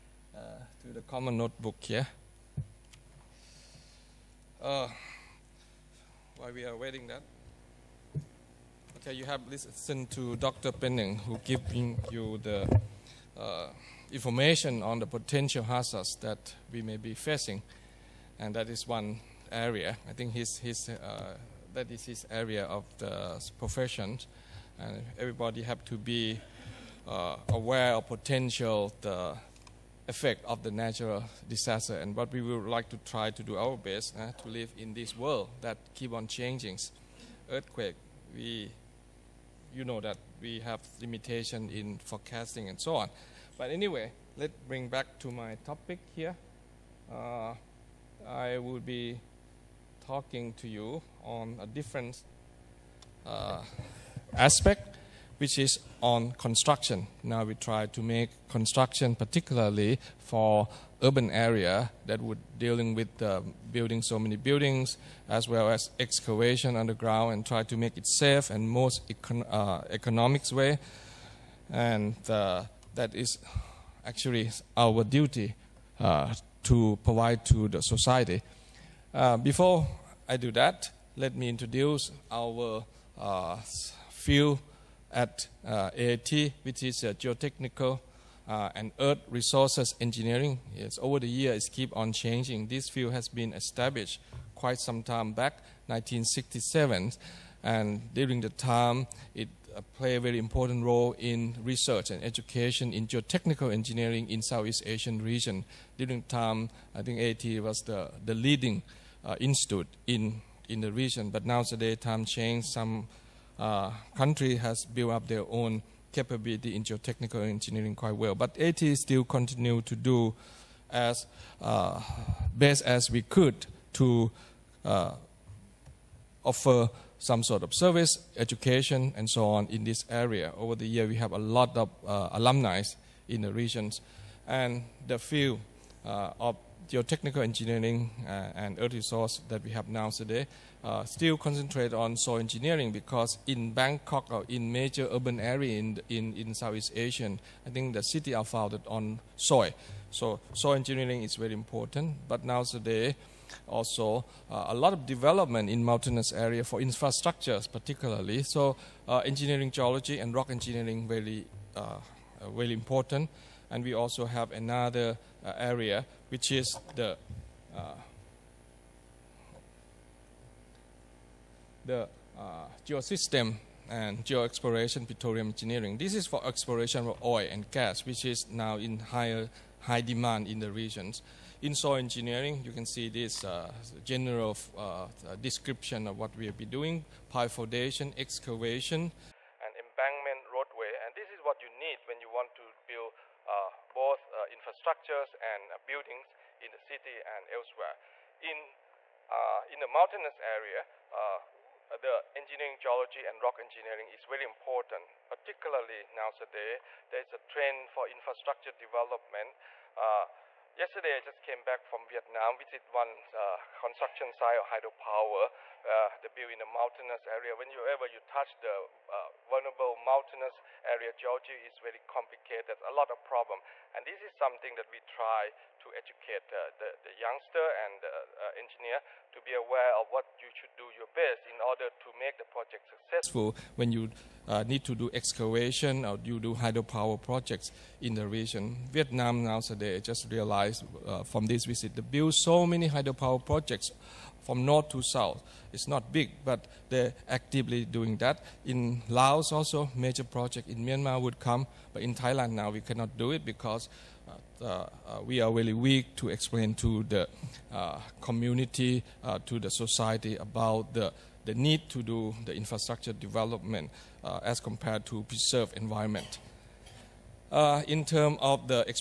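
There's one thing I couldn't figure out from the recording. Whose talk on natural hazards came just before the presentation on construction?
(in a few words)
Dr. Penning.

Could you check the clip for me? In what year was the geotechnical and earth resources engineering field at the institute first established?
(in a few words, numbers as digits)
1967.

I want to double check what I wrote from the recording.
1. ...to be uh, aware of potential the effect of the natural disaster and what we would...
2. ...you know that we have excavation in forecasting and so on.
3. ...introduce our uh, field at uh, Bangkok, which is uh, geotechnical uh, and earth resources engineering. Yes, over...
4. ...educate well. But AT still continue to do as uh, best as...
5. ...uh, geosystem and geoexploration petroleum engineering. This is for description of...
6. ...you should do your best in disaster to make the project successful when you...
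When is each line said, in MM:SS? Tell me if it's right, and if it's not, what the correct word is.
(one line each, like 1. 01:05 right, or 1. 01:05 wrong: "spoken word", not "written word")
1. 00:25 right
2. 00:39 wrong: "limitation", not "excavation"
3. 01:21 wrong: "AIT", not "Bangkok"
4. 01:57 wrong: "quite", not "educate"
5. 02:52 wrong: "exploration", not "description"
6. 03:50 wrong: "order", not "disaster".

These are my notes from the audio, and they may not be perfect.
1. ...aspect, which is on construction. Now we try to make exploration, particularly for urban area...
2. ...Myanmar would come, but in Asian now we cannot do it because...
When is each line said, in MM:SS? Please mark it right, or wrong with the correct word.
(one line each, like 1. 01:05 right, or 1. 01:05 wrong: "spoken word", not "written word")
1. 00:54 wrong: "construction", not "exploration"
2. 04:10 wrong: "Thailand", not "Asian".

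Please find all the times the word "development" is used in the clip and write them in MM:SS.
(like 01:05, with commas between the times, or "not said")
02:35, 03:28, 04:23.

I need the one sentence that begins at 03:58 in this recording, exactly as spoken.
Vietnam nowadays just realized uh, from this visit, they build so many hydropower projects from north to south.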